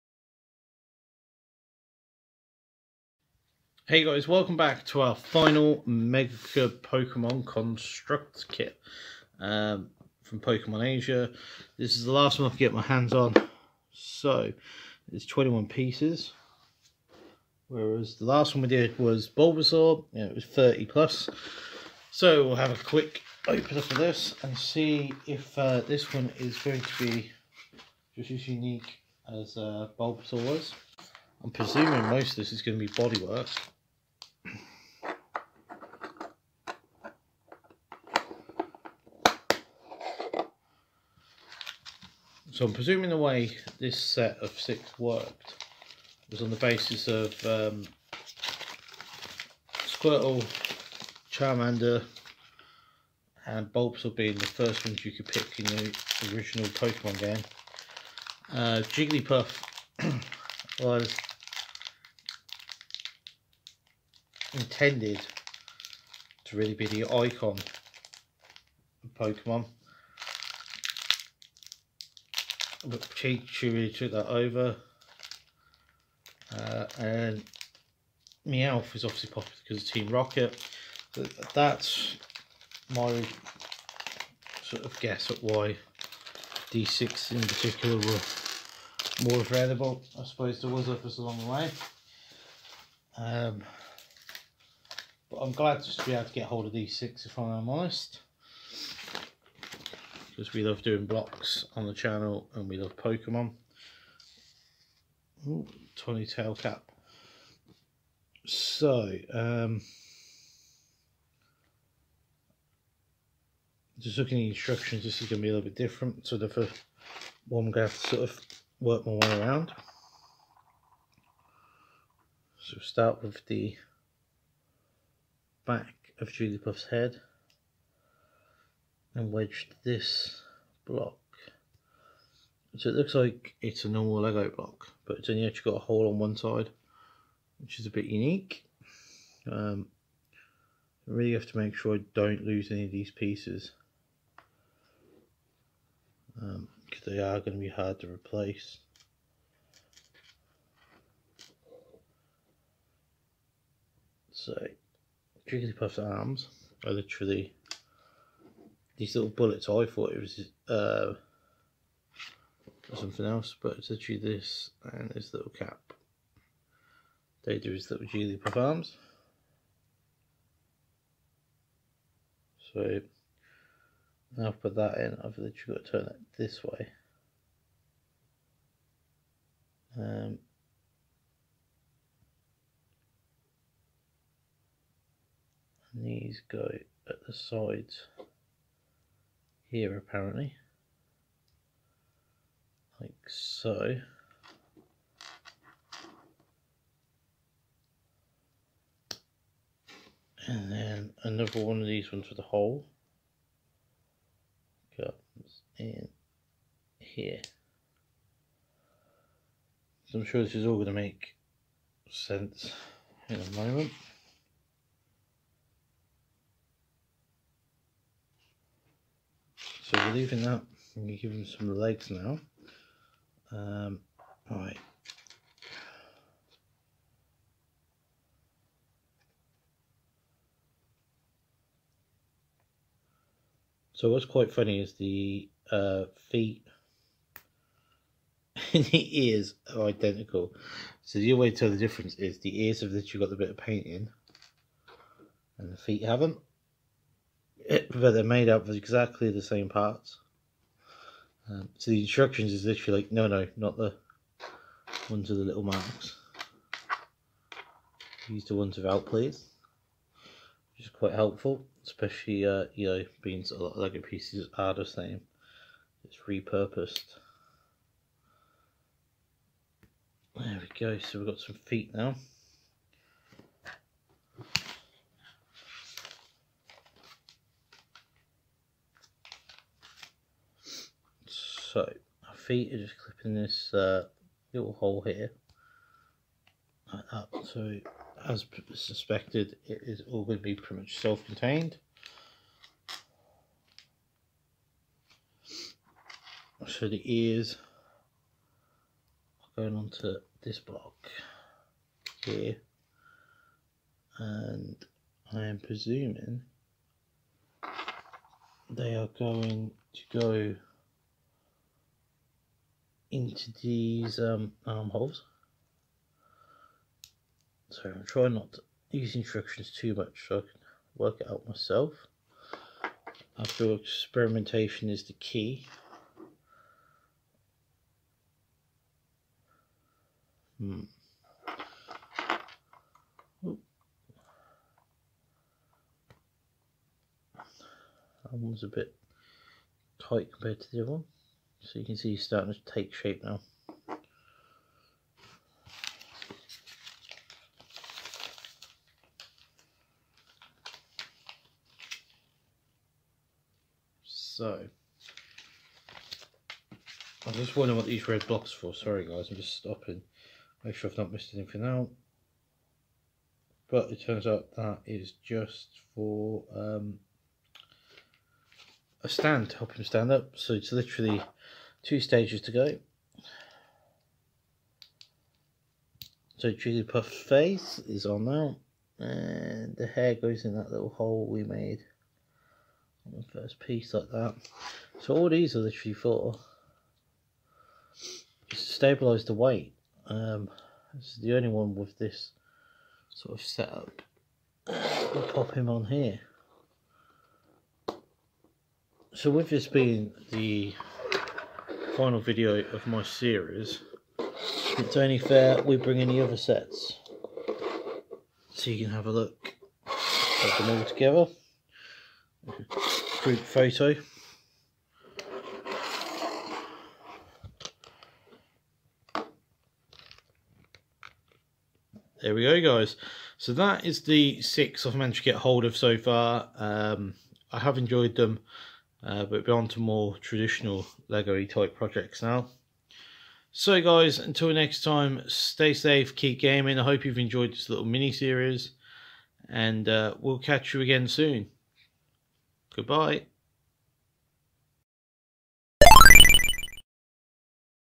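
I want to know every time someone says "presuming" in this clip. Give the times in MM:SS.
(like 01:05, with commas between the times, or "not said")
00:31, 00:42, 05:05.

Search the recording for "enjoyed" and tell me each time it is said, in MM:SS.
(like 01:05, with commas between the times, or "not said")
07:07, 07:17.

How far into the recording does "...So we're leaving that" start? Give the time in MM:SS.
03:39.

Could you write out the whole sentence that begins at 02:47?
They do his little Julie performs.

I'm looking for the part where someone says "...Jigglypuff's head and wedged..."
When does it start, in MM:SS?
02:06.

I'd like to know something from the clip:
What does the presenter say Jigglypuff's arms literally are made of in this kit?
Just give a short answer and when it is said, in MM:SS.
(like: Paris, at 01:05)
little bullets, at 02:39.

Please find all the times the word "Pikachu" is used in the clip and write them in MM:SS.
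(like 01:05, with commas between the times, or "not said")
01:13.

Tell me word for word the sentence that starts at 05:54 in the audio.
So, I was just wondering what these red blocks for.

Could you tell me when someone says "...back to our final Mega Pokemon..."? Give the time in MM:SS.
00:04.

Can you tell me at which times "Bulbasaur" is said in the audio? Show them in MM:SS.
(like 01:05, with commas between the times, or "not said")
00:19, 00:29, 00:53.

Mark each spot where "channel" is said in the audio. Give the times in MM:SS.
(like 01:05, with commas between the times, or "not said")
01:41.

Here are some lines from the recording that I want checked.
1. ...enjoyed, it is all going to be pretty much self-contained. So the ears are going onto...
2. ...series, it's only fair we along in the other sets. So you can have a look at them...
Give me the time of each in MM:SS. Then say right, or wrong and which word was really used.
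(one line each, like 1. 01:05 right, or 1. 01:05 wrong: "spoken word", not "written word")
1. 04:48 wrong: "suspected", not "enjoyed"
2. 06:43 wrong: "bring", not "along".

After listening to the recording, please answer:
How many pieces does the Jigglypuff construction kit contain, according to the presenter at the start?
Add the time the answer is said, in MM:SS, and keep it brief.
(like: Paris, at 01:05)
21, at 00:15.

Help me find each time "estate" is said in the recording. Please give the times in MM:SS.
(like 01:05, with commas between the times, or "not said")
not said.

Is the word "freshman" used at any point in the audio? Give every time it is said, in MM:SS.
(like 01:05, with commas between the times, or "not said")
not said.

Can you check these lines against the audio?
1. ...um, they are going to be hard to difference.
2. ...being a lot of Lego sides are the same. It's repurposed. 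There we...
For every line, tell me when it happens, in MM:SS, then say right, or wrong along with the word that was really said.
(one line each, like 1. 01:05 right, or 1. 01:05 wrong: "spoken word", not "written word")
1. 02:26 wrong: "replace", not "difference"
2. 04:23 wrong: "pieces", not "sides".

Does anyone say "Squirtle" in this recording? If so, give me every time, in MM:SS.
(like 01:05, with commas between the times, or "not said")
00:49.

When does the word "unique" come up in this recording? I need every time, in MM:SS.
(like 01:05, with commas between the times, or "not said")
00:28, 02:18.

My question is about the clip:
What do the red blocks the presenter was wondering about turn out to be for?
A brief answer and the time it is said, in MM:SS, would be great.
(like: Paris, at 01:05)
A stand, at 06:09.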